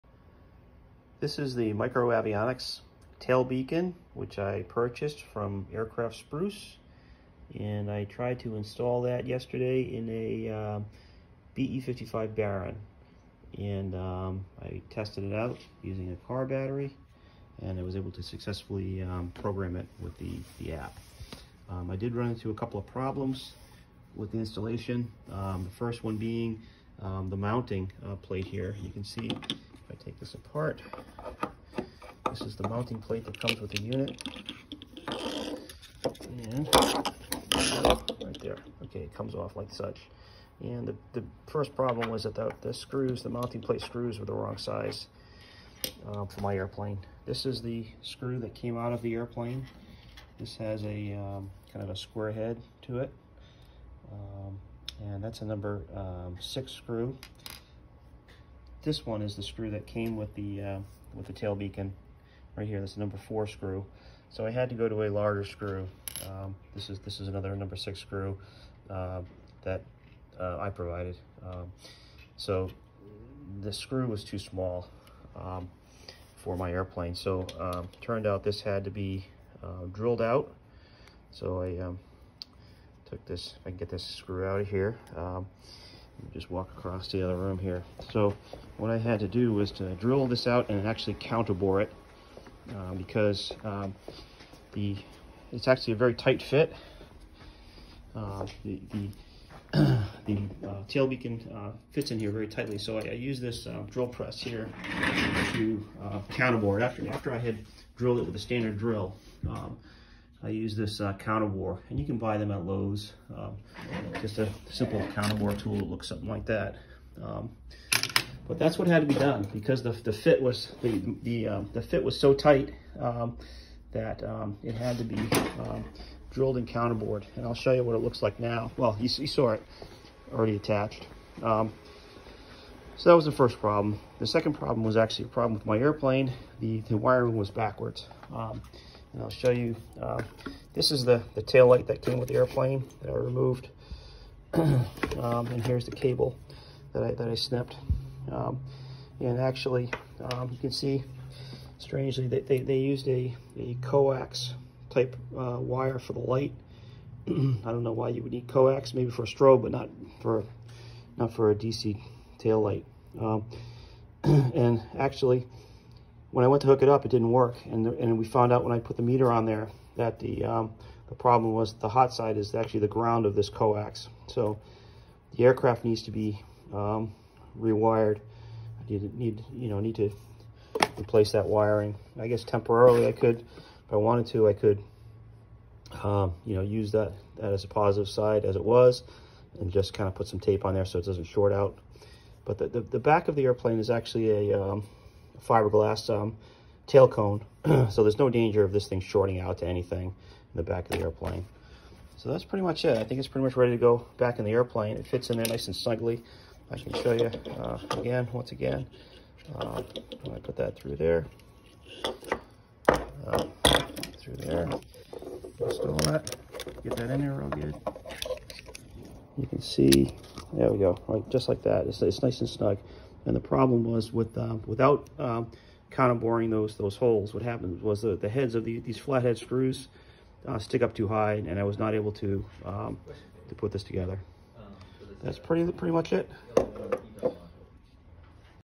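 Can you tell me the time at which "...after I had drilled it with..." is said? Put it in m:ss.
1:47.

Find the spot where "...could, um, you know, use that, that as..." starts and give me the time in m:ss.
3:04.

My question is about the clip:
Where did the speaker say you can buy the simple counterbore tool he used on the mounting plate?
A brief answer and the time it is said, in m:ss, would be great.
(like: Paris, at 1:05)
Lowe's, at 1:52.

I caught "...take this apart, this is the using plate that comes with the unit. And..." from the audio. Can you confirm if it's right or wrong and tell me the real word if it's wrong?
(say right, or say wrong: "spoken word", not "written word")
wrong: "mounting", not "using".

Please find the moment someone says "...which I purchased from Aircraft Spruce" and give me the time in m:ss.
0:04.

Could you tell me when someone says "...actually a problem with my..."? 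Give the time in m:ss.
2:14.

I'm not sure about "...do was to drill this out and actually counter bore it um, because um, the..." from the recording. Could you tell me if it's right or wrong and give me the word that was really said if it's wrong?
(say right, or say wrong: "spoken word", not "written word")
right.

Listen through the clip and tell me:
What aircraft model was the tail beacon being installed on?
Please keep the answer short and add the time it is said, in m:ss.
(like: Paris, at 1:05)
BE55 Baron, at 0:11.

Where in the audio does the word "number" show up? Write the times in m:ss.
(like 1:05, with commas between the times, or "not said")
0:55, 1:02, 1:07.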